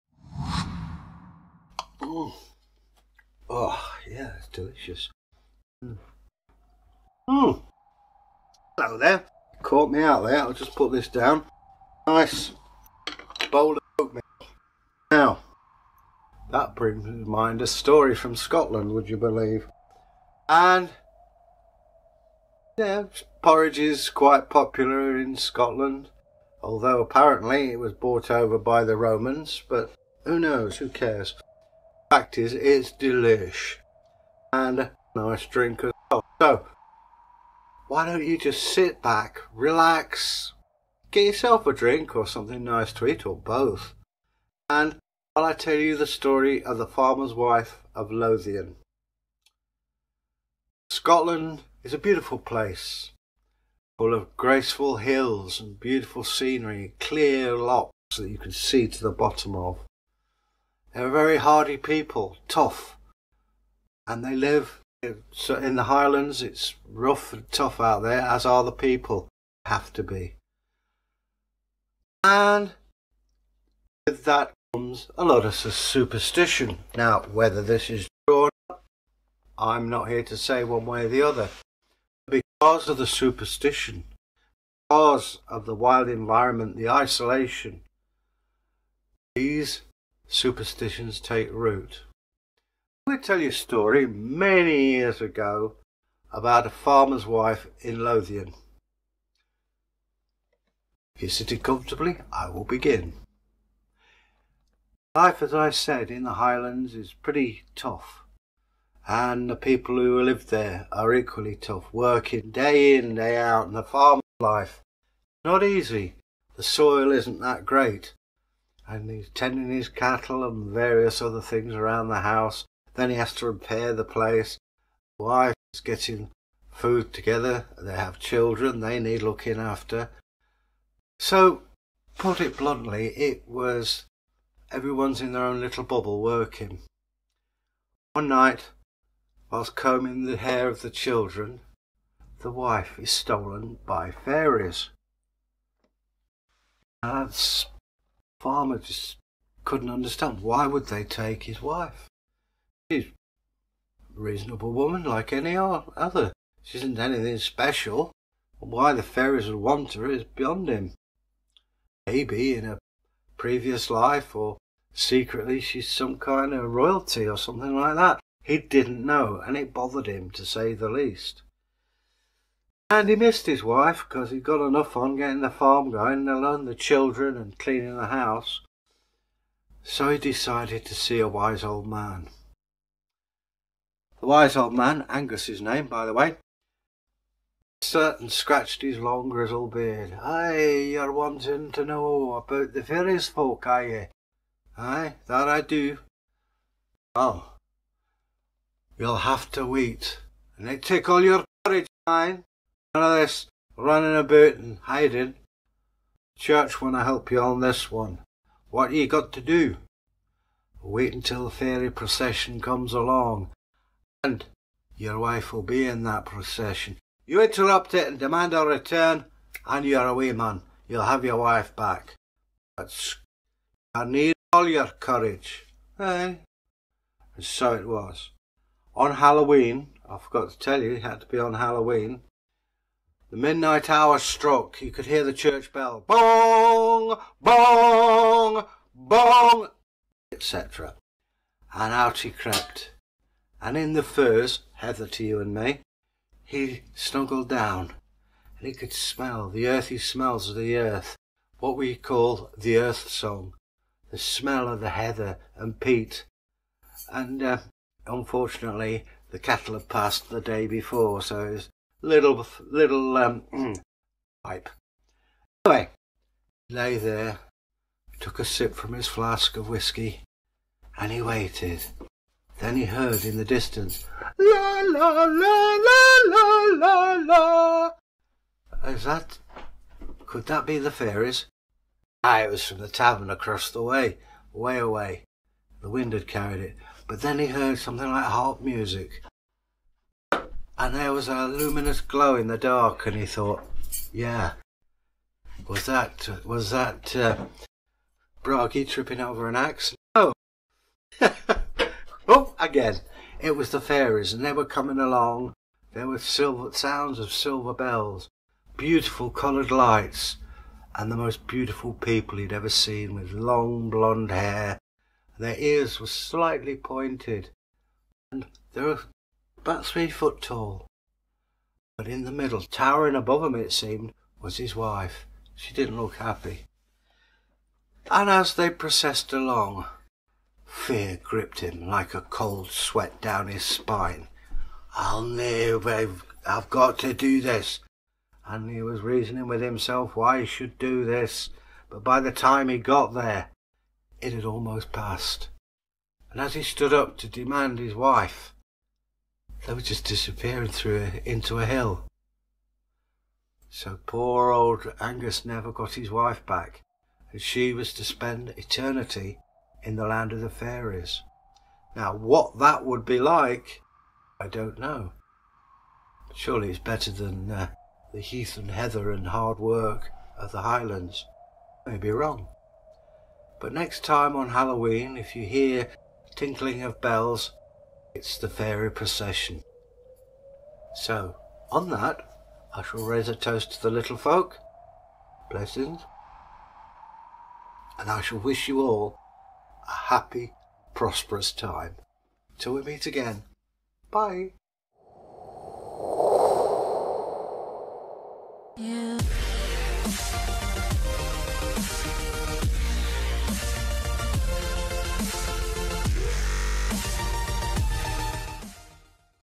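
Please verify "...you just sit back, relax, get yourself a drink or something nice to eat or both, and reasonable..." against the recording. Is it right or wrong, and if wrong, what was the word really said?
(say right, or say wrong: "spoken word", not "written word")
wrong: "while", not "reasonable".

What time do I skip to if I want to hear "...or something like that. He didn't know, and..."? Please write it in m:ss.
2:47.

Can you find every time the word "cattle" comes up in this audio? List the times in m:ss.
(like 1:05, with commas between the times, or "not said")
1:59, 4:19.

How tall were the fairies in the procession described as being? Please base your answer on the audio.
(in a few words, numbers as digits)
3 feet.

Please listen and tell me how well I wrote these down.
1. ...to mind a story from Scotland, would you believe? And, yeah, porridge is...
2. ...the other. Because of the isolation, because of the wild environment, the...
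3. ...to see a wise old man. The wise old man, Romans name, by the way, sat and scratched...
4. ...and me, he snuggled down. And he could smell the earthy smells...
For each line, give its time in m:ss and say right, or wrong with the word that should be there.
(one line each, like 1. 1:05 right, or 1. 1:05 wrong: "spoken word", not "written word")
1. 0:17 right
2. 1:21 wrong: "superstition", not "isolation"
3. 3:00 wrong: "Angus", not "Romans"
4. 4:05 right.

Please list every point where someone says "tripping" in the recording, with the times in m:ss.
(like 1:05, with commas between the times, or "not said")
4:58.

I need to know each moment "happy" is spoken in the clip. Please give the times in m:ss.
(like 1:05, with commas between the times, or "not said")
5:26, 6:29.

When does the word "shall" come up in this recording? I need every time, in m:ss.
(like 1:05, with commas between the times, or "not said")
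6:22, 6:28.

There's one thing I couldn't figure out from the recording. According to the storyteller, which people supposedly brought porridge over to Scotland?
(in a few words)
The Romans.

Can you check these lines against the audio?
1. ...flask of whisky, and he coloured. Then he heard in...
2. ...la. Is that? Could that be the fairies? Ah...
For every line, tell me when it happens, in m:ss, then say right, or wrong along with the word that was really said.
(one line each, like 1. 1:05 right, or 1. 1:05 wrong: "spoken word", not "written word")
1. 4:29 wrong: "waited", not "coloured"
2. 4:38 right.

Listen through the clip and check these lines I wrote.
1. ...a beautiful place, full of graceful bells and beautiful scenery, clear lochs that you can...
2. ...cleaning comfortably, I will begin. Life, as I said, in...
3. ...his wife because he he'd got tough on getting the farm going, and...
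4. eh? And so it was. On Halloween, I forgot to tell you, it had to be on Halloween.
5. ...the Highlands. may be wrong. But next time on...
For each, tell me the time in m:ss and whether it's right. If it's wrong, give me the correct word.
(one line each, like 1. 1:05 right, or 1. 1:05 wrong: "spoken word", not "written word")
1. 0:51 wrong: "hills", not "bells"
2. 1:41 wrong: "sitting", not "cleaning"
3. 2:53 wrong: "enough", not "tough"
4. 3:45 right
5. 6:10 right.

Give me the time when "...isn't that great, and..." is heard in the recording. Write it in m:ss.
1:57.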